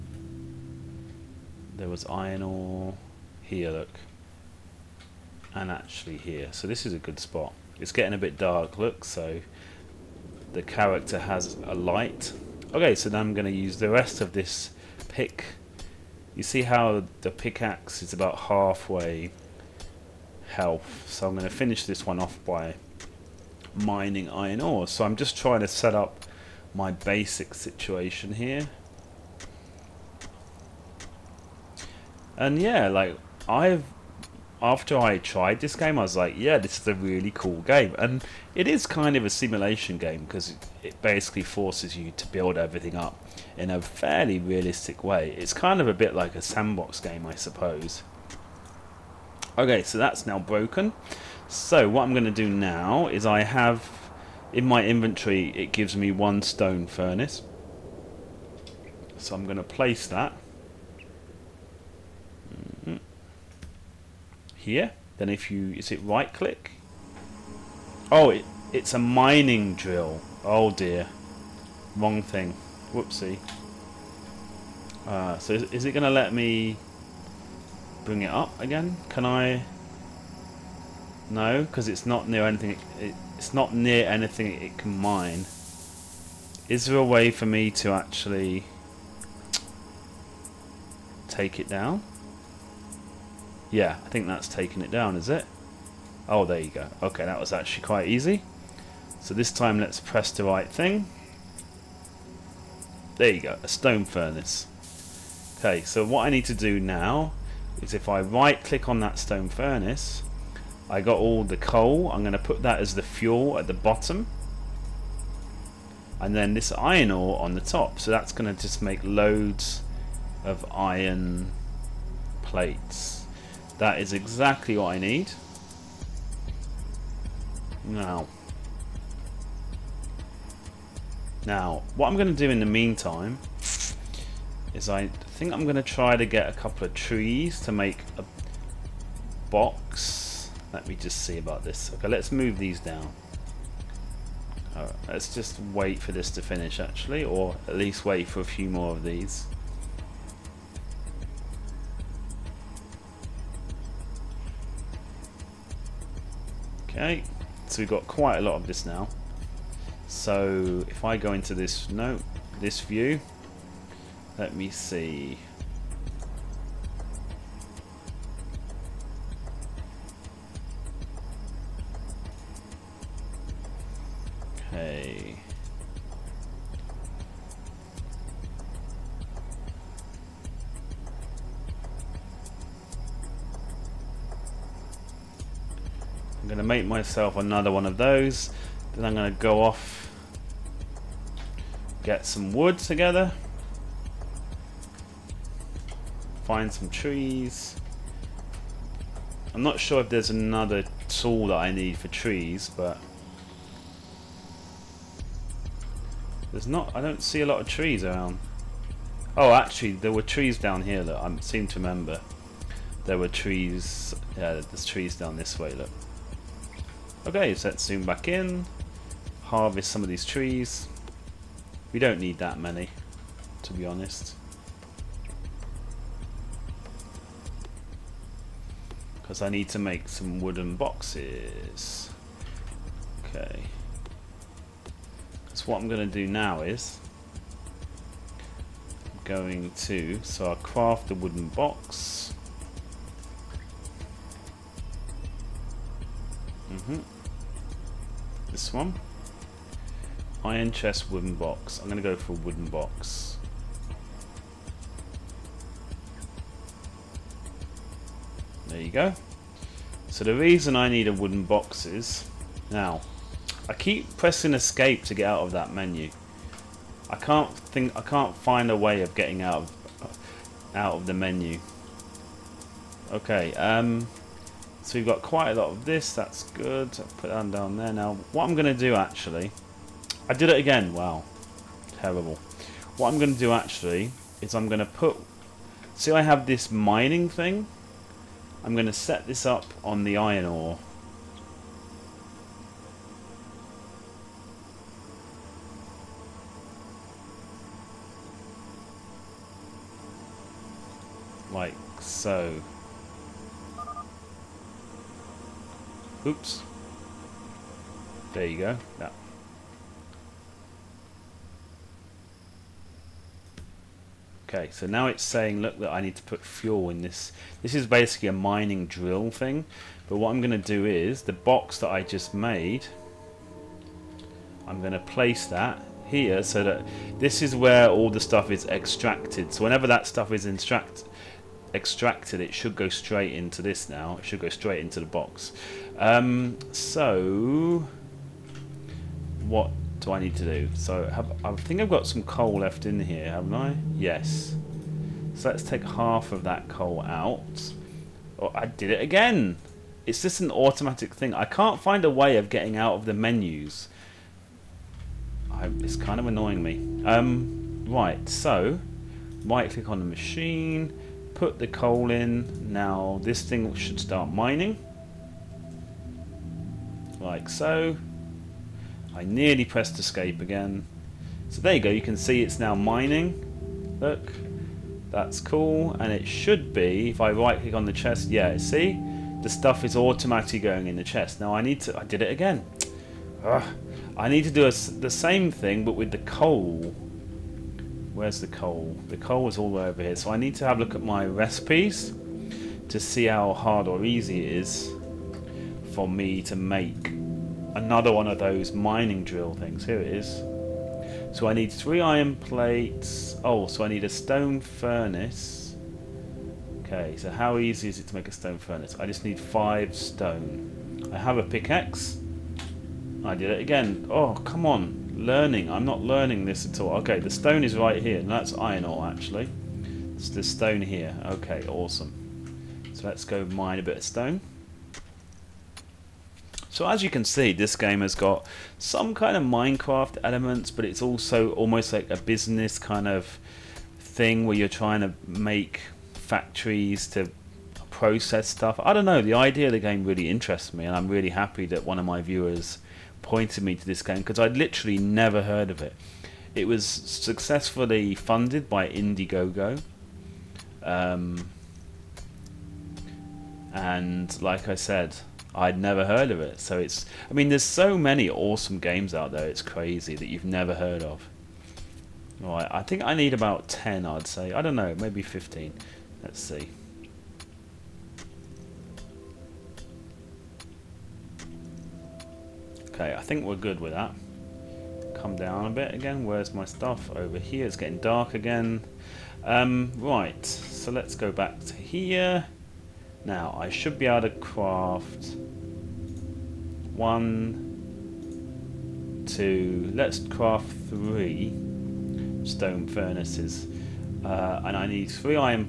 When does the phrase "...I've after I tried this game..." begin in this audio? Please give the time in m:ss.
0:33.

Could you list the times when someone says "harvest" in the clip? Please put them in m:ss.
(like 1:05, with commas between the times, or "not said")
3:39.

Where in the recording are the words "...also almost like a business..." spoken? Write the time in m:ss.
7:11.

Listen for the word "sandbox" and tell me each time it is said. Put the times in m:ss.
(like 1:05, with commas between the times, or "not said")
0:46.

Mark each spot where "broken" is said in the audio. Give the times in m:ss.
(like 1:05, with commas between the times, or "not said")
0:50.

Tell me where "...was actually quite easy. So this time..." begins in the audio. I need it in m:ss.
1:37.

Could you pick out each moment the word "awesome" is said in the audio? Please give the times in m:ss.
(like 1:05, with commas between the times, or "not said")
7:01, 7:38.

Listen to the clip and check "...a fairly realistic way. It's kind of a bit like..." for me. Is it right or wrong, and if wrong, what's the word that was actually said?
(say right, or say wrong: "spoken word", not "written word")
right.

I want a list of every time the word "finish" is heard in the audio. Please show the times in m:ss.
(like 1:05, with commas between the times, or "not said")
0:21, 2:26.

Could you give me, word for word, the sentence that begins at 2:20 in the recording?
Let me just see about this.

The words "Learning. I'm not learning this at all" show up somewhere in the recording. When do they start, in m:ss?
6:55.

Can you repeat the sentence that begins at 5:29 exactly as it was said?
So whenever that stuff is extracted, extracted it should go straight into this now.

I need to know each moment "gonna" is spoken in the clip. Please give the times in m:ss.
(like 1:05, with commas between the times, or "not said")
0:13, 0:21.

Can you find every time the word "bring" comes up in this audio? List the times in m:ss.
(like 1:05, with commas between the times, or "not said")
1:18.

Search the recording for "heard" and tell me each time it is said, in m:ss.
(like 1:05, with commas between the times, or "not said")
7:25, 7:36, 7:40.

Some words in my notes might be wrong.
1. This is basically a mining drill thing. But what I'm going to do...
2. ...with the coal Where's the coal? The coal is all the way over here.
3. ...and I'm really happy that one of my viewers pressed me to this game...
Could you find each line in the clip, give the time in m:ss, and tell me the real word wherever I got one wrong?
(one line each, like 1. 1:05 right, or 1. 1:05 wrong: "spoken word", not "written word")
1. 5:17 right
2. 6:25 right
3. 7:20 wrong: "pointed", not "pressed".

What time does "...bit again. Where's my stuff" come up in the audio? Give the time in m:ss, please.
7:55.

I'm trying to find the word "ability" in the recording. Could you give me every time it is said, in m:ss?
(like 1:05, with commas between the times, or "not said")
not said.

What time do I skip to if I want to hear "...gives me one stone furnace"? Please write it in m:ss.
0:55.